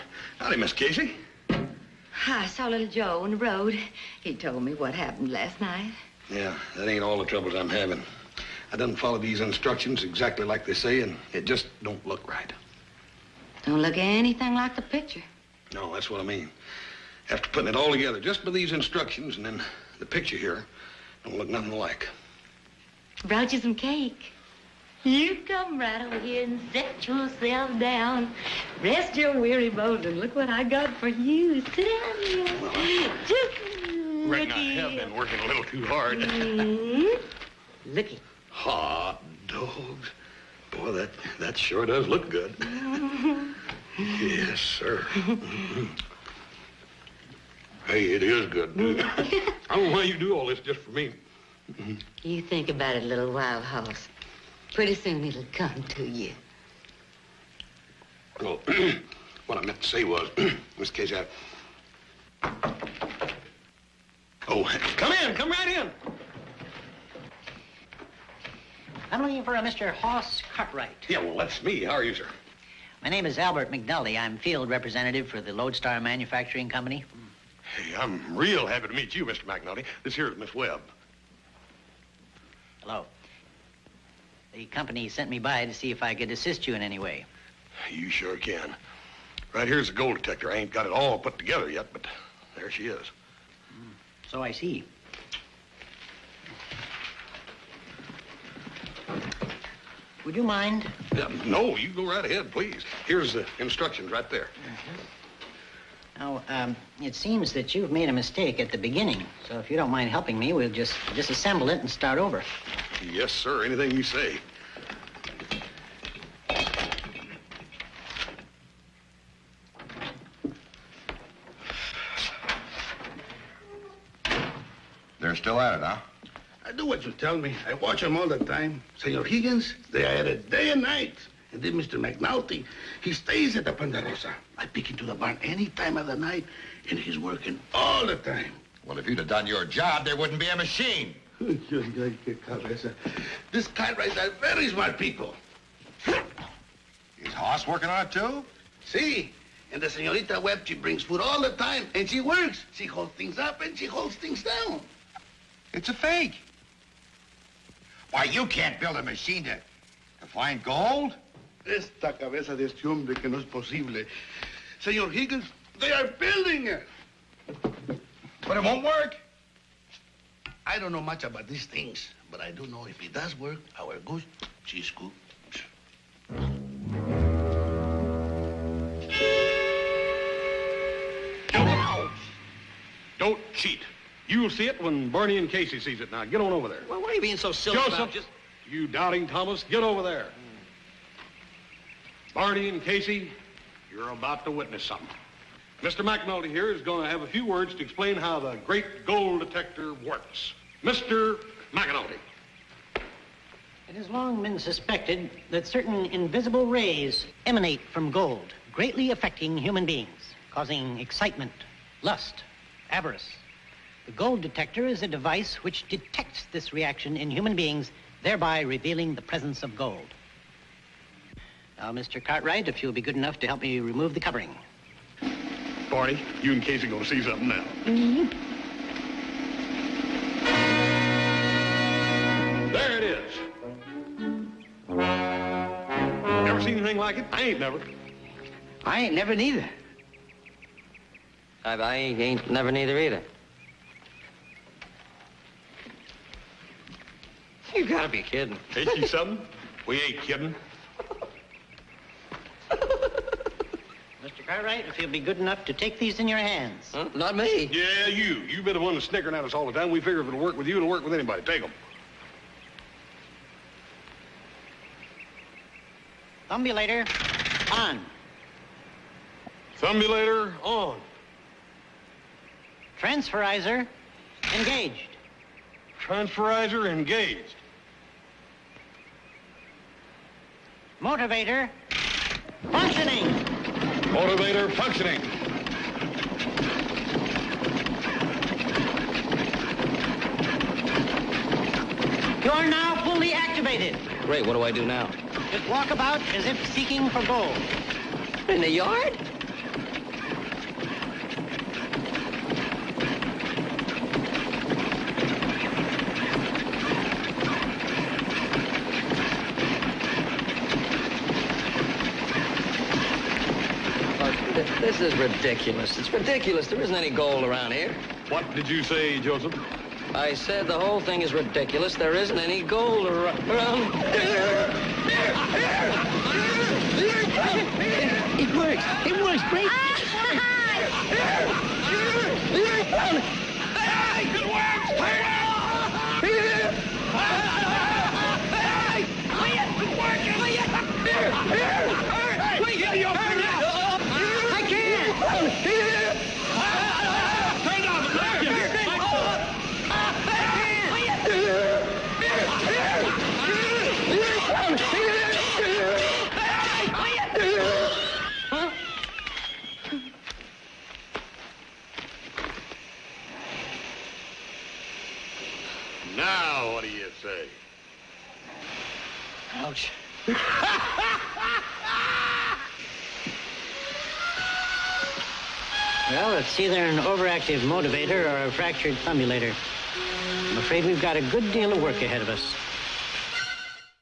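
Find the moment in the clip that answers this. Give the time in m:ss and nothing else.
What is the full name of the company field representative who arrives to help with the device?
1:13.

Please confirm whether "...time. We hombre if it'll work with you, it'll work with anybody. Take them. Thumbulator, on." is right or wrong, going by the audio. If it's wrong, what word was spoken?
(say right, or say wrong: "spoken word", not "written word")
wrong: "figure", not "hombre".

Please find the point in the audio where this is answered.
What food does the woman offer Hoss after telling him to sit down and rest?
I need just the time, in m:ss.
0:38.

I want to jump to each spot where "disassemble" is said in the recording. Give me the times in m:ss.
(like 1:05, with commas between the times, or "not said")
1:51.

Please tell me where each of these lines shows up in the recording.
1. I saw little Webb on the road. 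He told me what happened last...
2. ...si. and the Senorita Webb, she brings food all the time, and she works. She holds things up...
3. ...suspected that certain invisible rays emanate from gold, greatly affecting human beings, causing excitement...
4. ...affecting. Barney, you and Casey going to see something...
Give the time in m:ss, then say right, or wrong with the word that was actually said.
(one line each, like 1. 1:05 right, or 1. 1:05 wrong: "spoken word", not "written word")
1. 0:02 wrong: "Joe", not "Webb"
2. 2:28 right
3. 3:24 right
4. 3:44 wrong: "covering", not "affecting".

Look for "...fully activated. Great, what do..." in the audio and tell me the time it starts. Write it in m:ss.
4:53.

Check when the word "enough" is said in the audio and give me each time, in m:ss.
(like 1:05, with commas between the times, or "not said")
3:43, 4:15.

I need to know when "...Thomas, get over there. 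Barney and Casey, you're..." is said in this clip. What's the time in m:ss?
3:09.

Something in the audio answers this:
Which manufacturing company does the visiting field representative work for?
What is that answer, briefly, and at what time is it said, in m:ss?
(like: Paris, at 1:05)
Lodestar Manufacturing Company, at 1:15.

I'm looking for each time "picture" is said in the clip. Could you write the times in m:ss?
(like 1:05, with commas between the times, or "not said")
0:14, 0:20.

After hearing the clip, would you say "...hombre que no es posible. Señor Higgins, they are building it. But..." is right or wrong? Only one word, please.
right.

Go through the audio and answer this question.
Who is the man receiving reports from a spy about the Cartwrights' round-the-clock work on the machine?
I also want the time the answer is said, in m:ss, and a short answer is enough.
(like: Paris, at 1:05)
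Señor Higgins, at 2:08.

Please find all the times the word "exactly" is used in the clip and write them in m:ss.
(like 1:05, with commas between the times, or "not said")
0:10.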